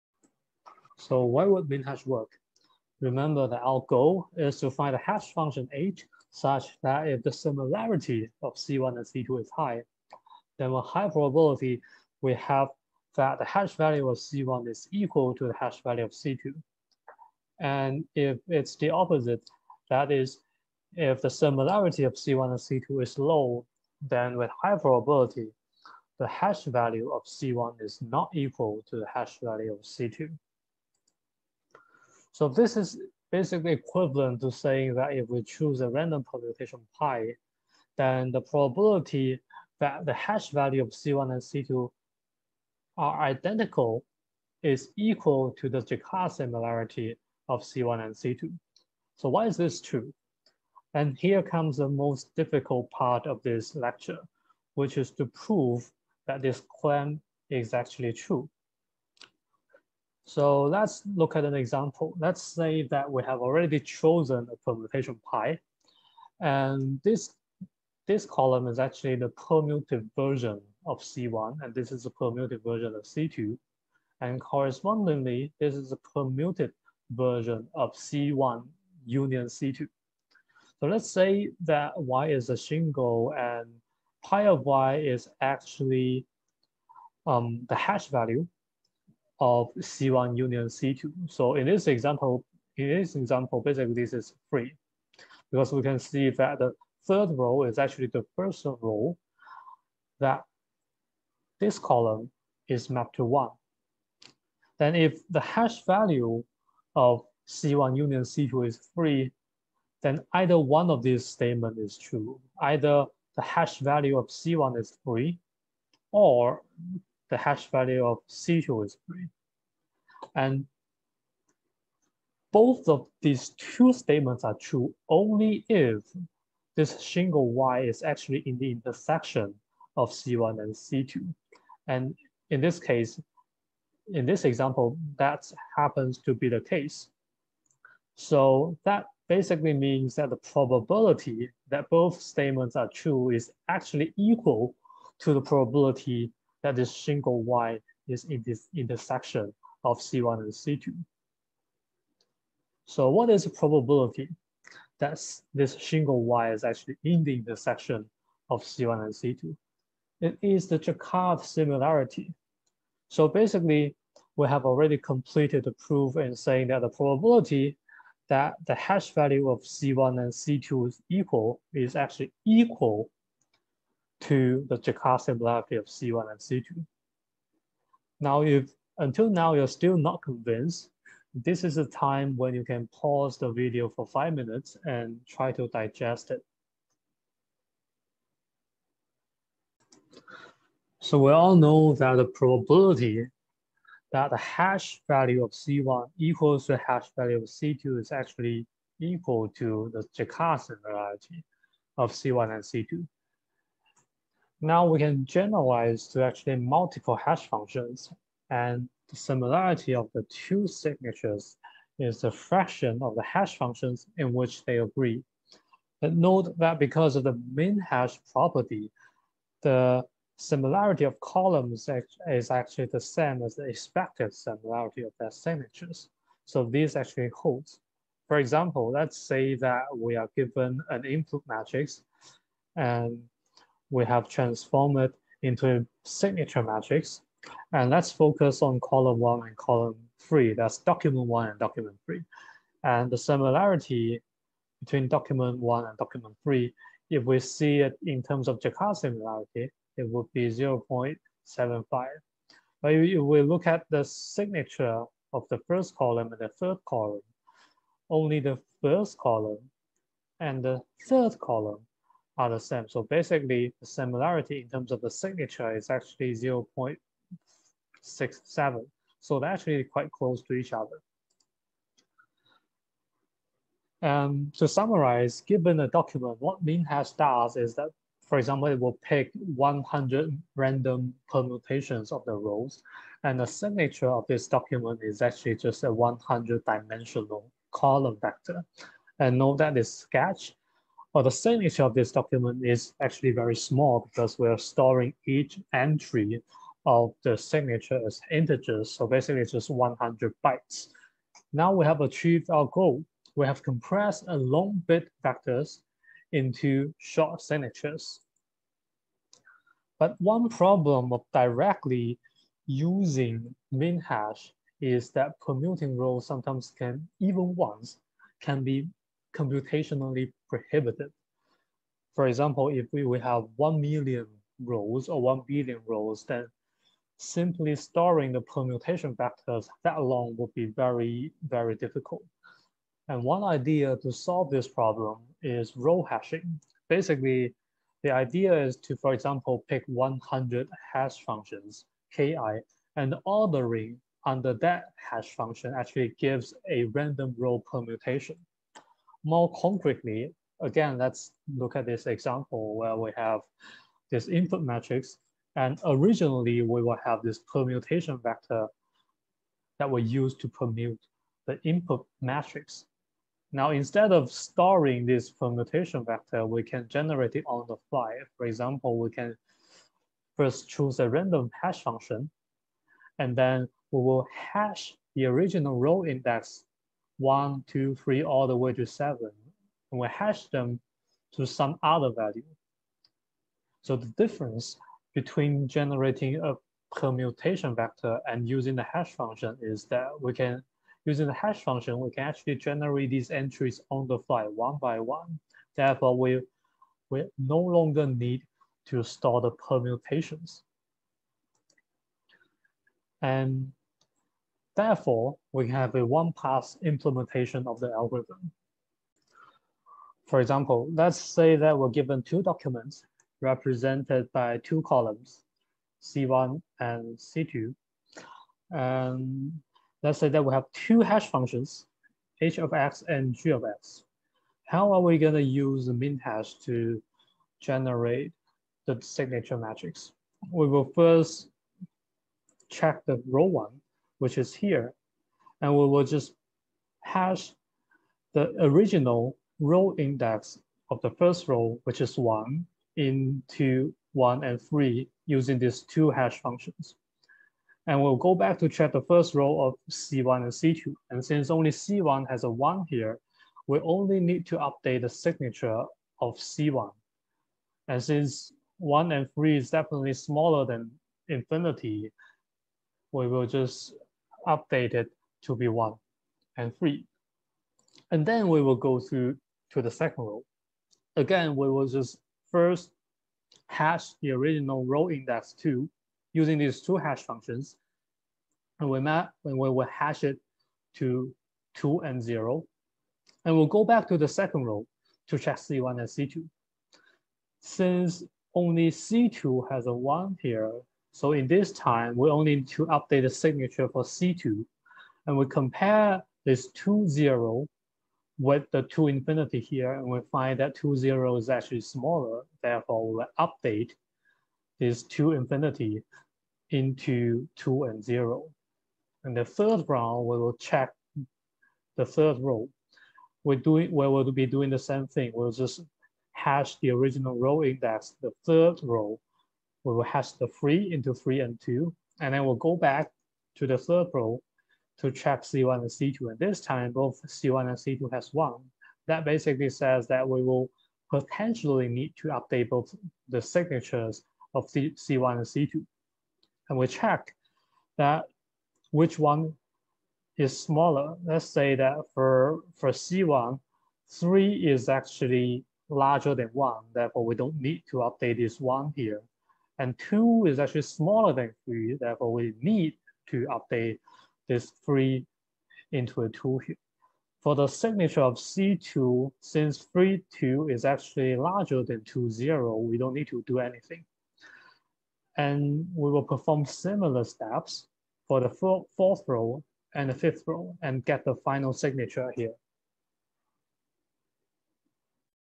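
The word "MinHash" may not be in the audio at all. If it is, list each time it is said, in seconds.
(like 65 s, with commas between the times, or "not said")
276 s.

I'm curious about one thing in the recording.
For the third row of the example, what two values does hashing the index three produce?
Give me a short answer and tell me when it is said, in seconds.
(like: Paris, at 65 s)
3 and 2, at 521 s.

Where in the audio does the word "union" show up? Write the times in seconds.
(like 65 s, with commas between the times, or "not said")
79 s, 90 s, 107 s.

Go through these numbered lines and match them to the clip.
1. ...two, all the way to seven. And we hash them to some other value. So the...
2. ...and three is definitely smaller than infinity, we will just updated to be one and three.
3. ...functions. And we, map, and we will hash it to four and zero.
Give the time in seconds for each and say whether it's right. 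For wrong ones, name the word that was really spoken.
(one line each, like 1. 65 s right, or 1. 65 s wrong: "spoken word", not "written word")
1. 378 s wrong: "three", not "two"
2. 459 s right
3. 477 s wrong: "two", not "four".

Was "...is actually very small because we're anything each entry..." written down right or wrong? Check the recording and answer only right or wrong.
wrong.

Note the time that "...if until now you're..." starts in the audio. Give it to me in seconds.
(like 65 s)
178 s.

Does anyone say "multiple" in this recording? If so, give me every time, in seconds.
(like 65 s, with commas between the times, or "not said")
206 s.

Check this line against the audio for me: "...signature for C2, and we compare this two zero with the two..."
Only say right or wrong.
right.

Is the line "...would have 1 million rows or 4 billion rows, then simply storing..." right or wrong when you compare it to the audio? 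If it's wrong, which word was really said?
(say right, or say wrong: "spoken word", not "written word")
wrong: "1", not "4".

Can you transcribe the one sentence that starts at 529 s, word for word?
That basically says that we will potentially need to update both the signatures of C C1 and C2.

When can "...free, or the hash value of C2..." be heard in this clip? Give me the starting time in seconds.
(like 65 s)
115 s.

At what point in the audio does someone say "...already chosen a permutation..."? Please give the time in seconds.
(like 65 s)
63 s.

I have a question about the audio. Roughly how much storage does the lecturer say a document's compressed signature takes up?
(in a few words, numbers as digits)
100 bytes.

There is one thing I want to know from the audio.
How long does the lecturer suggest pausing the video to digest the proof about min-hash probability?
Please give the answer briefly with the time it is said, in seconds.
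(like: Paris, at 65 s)
5 minutes, at 184 s.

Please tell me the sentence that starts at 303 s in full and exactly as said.
We have compressed a long bit vectors into short signatures.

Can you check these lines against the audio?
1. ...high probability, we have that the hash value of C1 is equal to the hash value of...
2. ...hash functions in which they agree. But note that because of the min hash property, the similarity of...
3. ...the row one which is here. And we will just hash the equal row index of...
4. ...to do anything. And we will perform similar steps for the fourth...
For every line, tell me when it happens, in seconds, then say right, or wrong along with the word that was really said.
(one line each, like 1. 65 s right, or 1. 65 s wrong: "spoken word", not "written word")
1. 10 s right
2. 213 s right
3. 433 s wrong: "original", not "equal"
4. 563 s right.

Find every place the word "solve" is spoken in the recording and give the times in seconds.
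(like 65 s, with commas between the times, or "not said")
334 s.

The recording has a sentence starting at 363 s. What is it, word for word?
Now, instead of storing this permutation vector, we can generate it on the fly.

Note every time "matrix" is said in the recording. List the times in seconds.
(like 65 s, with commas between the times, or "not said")
231 s, 236 s, 354 s, 362 s, 429 s.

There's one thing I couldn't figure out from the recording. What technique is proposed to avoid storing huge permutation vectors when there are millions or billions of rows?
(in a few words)
Row hashing.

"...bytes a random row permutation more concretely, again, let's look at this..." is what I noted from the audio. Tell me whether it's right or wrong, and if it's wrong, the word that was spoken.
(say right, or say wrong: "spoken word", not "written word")
wrong: "gives", not "bytes".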